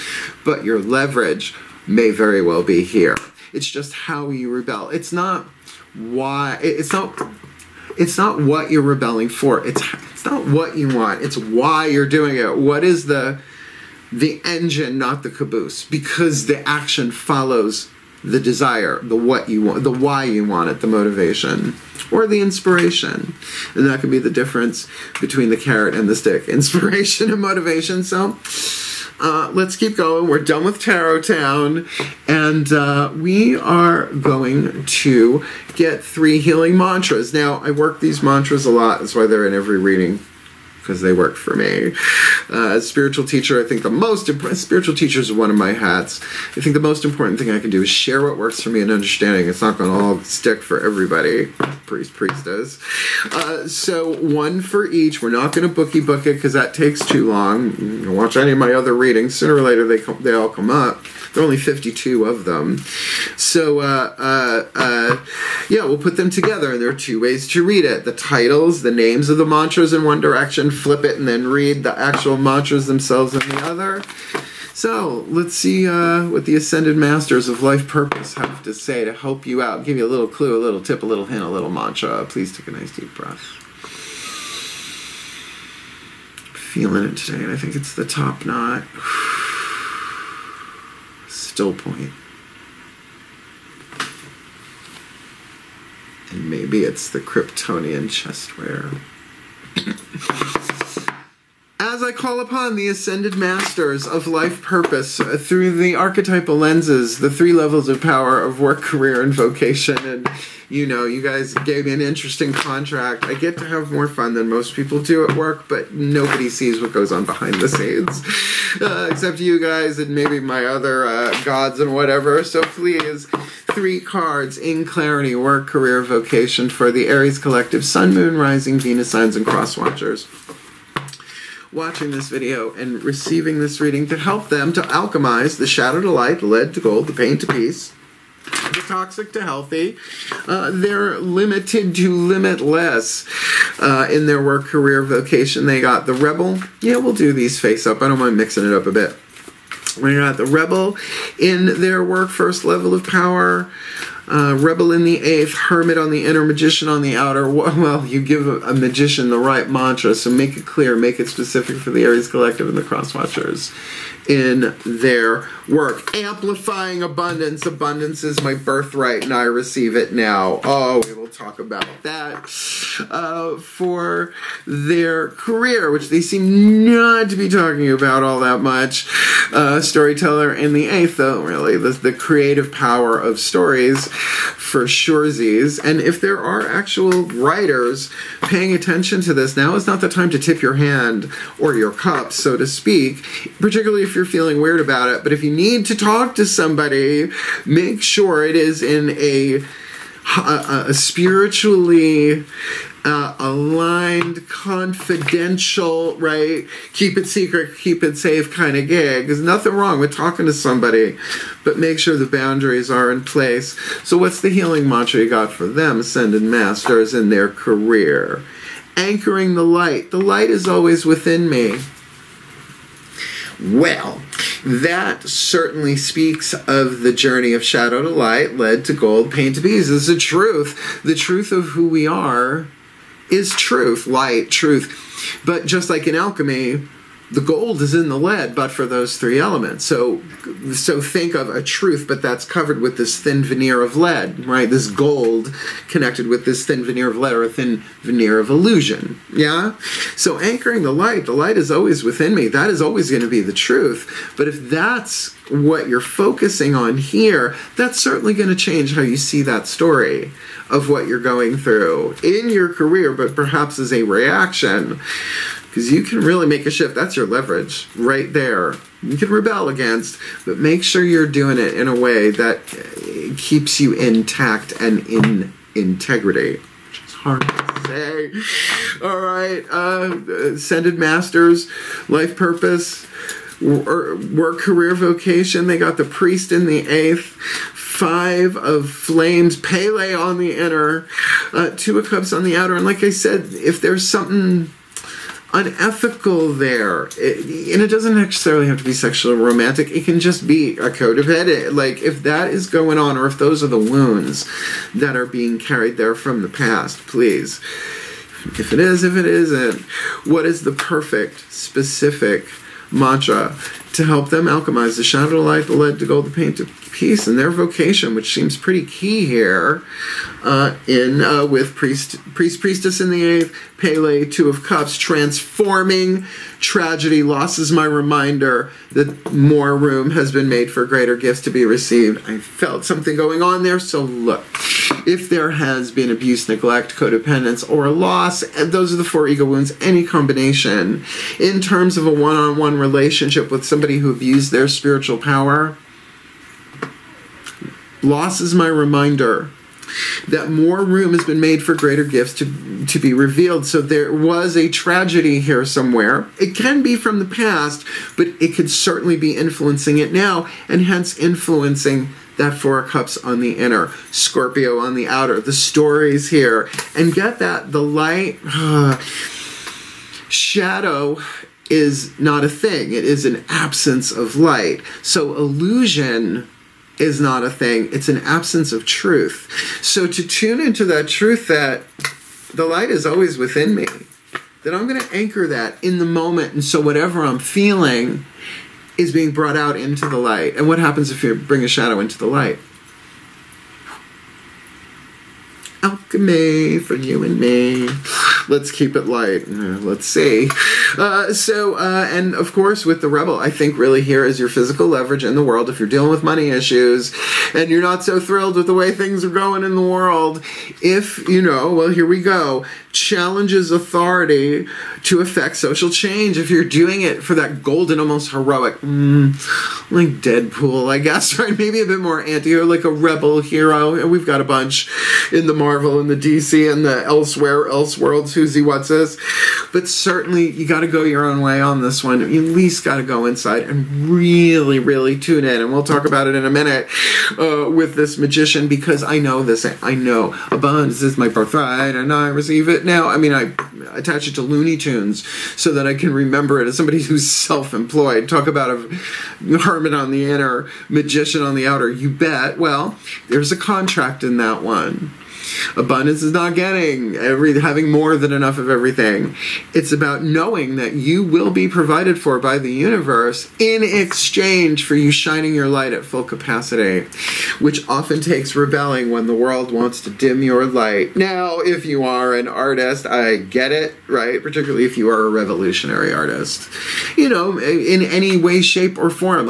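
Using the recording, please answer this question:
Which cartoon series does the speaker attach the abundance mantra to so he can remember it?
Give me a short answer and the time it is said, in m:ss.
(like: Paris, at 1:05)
Looney Tunes, at 7:24.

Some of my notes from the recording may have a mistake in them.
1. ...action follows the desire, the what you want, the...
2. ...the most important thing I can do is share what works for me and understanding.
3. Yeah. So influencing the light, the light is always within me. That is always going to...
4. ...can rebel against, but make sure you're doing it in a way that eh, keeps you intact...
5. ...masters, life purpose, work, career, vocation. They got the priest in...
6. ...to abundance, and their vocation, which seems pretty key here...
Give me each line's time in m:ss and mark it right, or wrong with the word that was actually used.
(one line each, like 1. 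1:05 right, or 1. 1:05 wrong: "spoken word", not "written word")
1. 0:16 right
2. 0:46 right
3. 4:09 wrong: "anchoring", not "influencing"
4. 4:29 right
5. 4:40 right
6. 5:16 wrong: "peace", not "abundance".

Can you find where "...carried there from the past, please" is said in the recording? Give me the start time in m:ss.
5:05.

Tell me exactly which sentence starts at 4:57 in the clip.
It, and it doesn't necessarily have to be sexual or romantic.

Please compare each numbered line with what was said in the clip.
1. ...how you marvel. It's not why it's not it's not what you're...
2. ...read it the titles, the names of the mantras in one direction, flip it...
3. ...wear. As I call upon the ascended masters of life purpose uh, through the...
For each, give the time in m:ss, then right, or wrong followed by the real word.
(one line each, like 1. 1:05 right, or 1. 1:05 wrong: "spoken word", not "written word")
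1. 0:03 wrong: "rebel", not "marvel"
2. 1:07 right
3. 1:38 right.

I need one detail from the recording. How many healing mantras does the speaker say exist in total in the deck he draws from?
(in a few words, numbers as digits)
52.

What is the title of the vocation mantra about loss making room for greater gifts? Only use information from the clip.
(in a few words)
Transforming tragedy.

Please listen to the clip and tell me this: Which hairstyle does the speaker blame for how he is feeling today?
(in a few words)
top knot.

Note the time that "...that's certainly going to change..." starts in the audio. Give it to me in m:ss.
4:17.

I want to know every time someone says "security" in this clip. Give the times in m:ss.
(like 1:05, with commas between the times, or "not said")
not said.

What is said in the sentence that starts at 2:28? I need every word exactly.
I don't mind mixing it up a bit.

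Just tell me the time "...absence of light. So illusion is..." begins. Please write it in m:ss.
6:13.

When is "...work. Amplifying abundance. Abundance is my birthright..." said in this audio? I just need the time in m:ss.
2:45.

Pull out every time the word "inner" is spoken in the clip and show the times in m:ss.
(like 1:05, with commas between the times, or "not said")
2:36, 4:50, 6:03, 7:30.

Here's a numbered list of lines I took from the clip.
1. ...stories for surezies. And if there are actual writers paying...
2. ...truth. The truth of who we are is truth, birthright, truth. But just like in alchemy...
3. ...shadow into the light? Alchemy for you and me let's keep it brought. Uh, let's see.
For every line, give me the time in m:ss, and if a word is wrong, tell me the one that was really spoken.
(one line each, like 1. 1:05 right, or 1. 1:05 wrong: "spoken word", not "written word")
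1. 3:03 right
2. 3:50 wrong: "light", not "birthright"
3. 6:31 wrong: "light", not "brought".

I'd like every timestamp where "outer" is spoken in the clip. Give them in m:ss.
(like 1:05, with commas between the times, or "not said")
2:37, 4:52, 6:05, 7:31.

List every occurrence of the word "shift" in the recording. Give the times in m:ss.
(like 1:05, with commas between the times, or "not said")
4:26.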